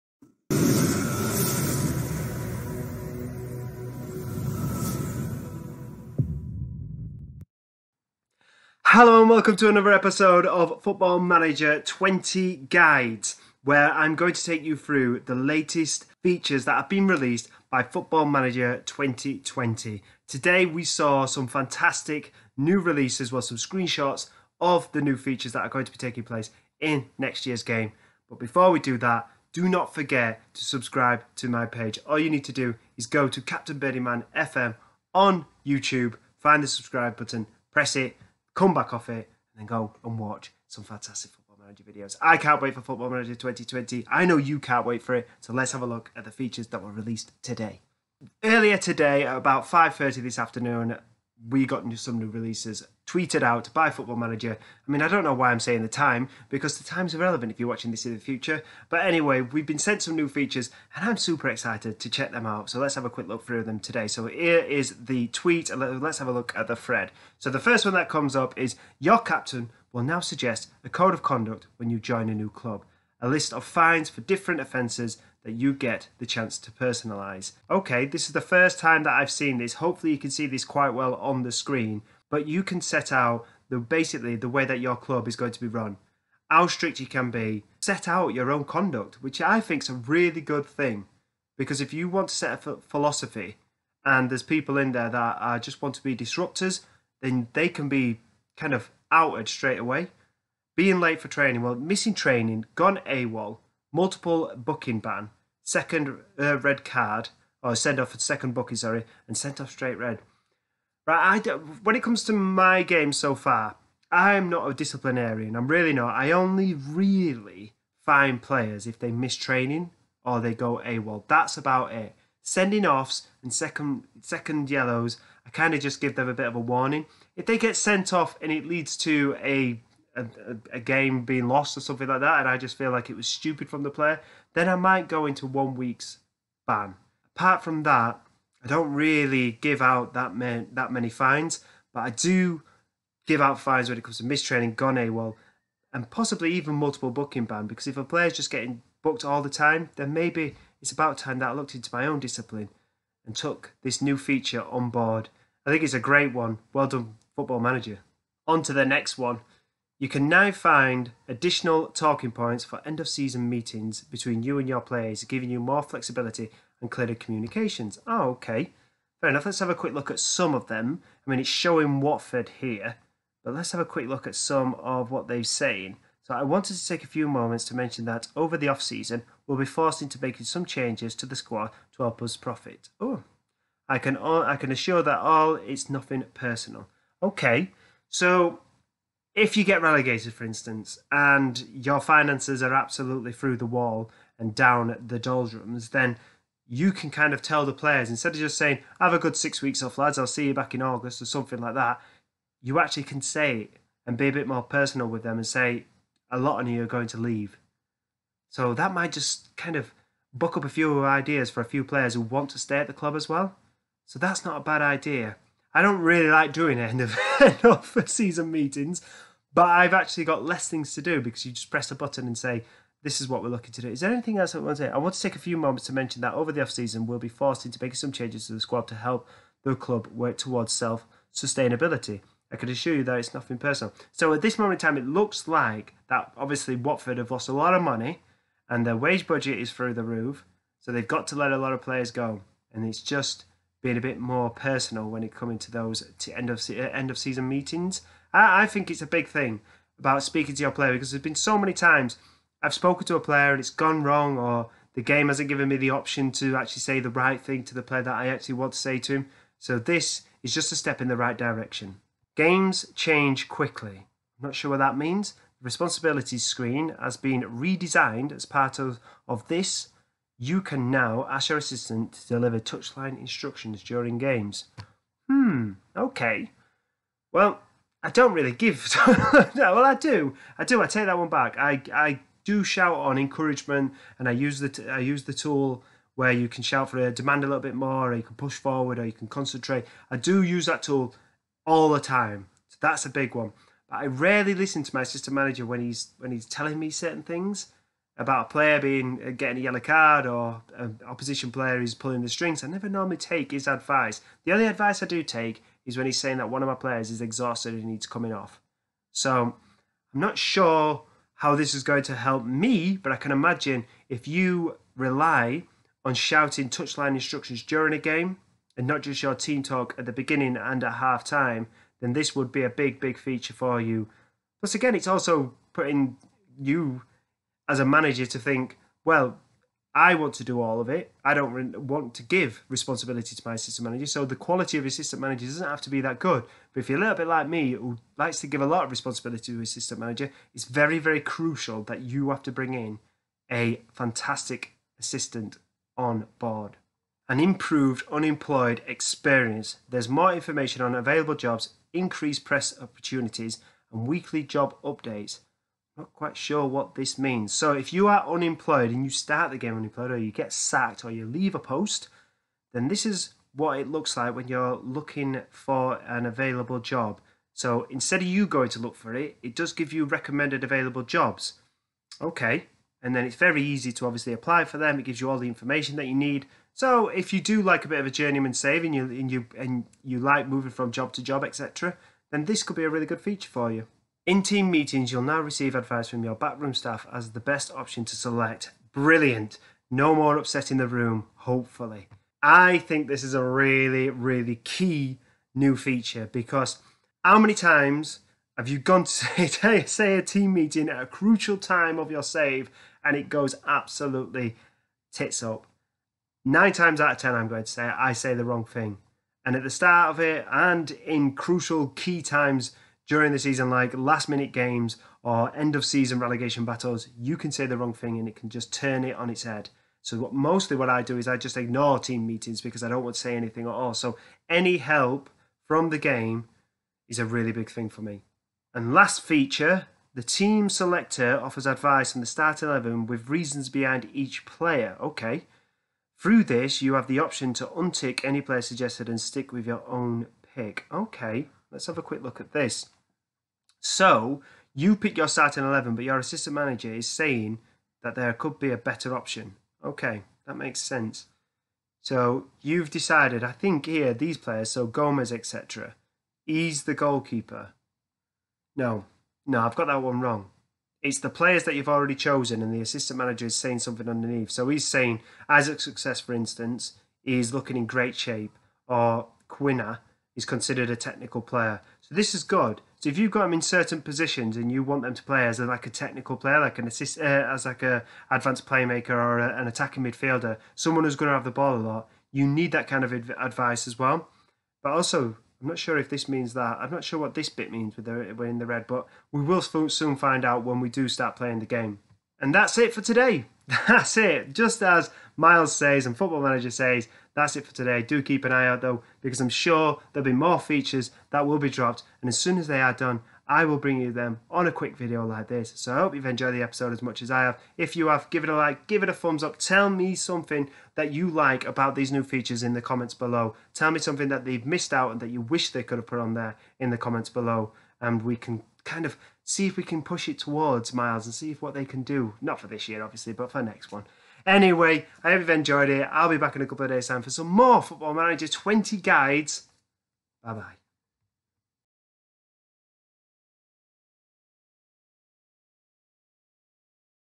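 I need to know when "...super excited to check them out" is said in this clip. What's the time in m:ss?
1:01.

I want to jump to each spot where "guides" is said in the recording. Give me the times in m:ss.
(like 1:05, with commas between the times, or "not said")
0:12, 8:48.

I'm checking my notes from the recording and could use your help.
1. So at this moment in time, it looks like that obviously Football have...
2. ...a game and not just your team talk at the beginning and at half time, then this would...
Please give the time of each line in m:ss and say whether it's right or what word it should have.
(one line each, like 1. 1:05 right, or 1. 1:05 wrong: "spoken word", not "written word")
1. 3:54 wrong: "Watford", not "Football"
2. 5:17 right.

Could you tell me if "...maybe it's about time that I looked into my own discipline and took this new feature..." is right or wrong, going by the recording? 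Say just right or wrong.
right.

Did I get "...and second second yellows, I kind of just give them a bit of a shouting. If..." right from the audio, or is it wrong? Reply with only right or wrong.
wrong.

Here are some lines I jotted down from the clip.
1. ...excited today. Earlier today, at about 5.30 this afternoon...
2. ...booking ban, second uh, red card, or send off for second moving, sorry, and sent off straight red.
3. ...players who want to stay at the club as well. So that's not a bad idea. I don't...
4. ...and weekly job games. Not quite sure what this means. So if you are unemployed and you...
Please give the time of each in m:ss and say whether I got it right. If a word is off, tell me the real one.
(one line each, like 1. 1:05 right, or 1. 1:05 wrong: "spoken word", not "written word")
1. 0:46 wrong: "released", not "excited"
2. 1:44 wrong: "booking", not "moving"
3. 3:31 right
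4. 5:53 wrong: "updates", not "games".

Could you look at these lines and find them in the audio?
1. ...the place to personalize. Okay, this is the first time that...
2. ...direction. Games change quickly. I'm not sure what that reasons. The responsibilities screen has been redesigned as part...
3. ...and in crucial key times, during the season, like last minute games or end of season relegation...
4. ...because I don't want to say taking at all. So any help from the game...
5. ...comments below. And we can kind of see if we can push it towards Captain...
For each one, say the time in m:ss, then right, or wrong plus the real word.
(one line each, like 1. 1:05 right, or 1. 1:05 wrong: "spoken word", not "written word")
1. 1:16 wrong: "chance", not "place"
2. 4:21 wrong: "means", not "reasons"
3. 6:50 right
4. 7:02 wrong: "anything", not "taking"
5. 8:36 wrong: "Miles", not "Captain".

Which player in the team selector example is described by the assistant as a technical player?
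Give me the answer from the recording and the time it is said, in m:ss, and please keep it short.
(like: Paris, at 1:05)
Quina, at 7:49.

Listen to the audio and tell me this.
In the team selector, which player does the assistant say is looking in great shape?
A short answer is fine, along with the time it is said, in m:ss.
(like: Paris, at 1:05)
Isaac Success, at 7:45.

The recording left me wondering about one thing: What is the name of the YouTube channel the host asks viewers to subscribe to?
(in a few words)
Captain Man FM.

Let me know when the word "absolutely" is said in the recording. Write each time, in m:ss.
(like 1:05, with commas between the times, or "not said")
3:12, 6:43.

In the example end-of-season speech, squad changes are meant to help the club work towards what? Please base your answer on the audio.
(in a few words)
Self-sustainability.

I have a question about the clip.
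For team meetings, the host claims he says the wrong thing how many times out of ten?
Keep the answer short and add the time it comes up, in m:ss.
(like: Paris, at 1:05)
9, at 6:46.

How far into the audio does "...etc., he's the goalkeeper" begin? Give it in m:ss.
7:35.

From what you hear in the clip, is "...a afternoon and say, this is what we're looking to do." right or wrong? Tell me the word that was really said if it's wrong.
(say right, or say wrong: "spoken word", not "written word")
wrong: "button", not "afternoon".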